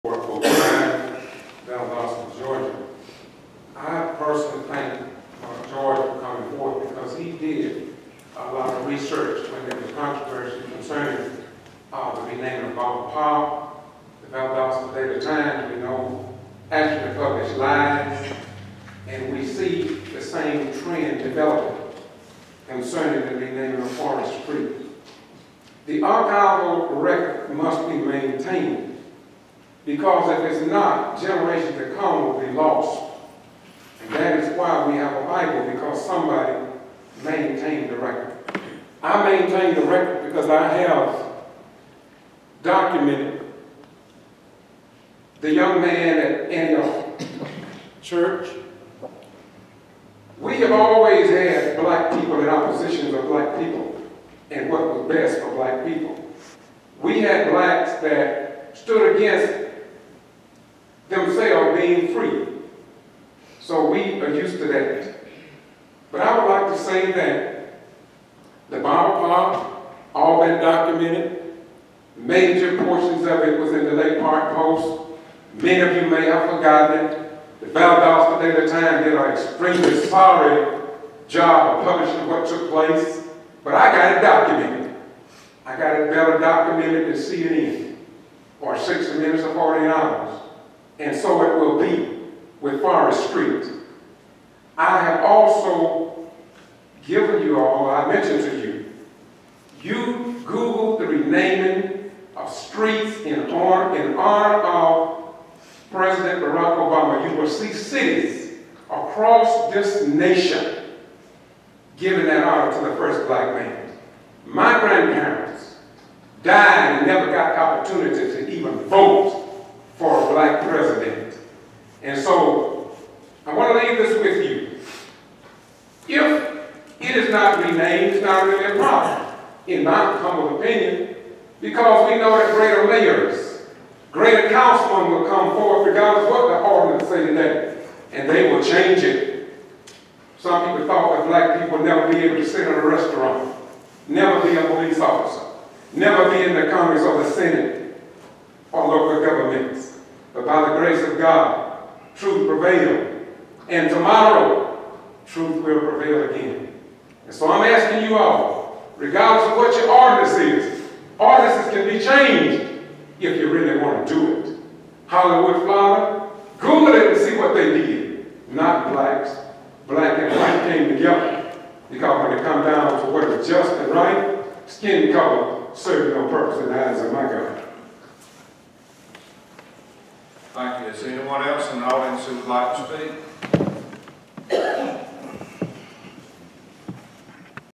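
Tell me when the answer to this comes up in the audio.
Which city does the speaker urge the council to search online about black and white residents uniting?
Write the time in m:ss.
2:45.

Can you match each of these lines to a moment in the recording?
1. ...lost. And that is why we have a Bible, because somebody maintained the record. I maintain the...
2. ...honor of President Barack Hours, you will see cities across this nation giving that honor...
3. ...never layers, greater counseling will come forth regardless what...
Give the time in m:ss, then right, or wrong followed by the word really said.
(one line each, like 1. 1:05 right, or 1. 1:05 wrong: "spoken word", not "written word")
1. 0:32 right
2. 1:44 wrong: "Obama", not "Hours"
3. 2:12 wrong: "greater", not "never".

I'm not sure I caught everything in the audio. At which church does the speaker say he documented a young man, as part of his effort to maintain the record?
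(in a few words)
Antioch Church.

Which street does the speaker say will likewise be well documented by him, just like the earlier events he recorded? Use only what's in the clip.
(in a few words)
Forrest Street.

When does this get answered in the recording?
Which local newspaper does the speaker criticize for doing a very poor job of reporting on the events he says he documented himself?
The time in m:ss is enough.
1:17.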